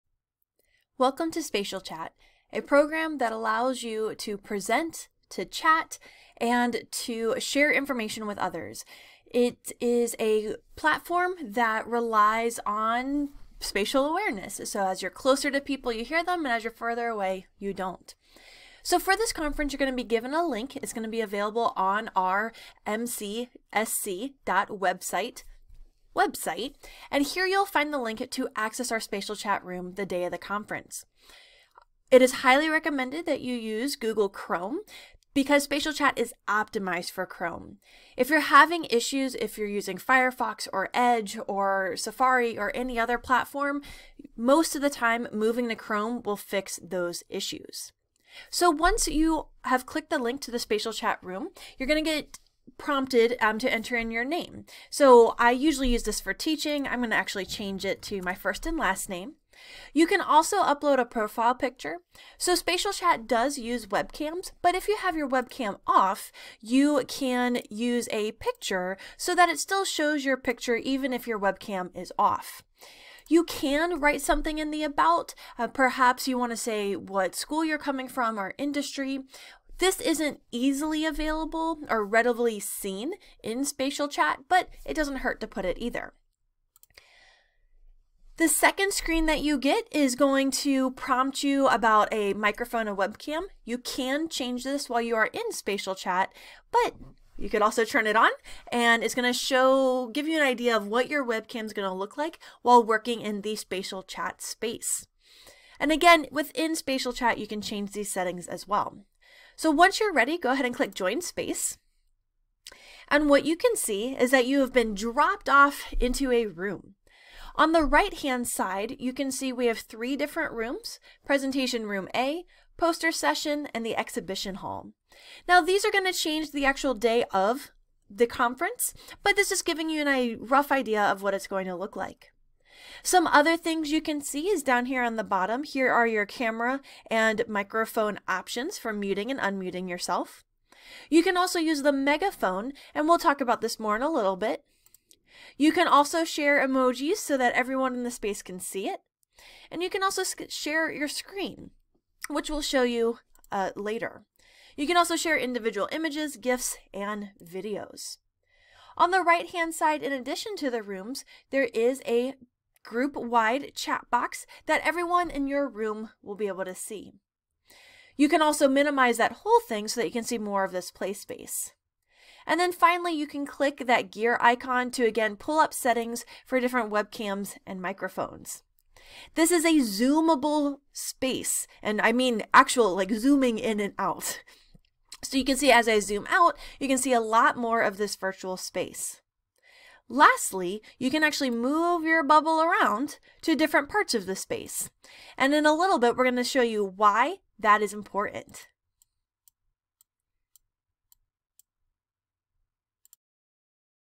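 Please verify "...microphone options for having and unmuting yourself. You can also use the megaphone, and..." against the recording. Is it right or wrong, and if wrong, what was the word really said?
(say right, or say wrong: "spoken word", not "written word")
wrong: "muting", not "having".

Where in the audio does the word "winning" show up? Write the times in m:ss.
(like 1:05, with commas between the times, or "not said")
not said.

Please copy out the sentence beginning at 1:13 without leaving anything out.
You can write something in the about.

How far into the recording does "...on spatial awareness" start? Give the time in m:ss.
0:12.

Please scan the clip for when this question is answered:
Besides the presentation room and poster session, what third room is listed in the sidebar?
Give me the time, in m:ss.
2:03.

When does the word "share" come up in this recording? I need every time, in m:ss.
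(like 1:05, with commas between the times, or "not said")
0:07, 2:26, 2:30, 2:35.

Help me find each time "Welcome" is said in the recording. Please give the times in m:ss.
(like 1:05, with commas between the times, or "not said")
0:01.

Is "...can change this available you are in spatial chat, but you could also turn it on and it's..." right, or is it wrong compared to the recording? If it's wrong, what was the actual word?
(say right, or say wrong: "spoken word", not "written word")
wrong: "while", not "available".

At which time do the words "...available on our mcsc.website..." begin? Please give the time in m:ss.
0:21.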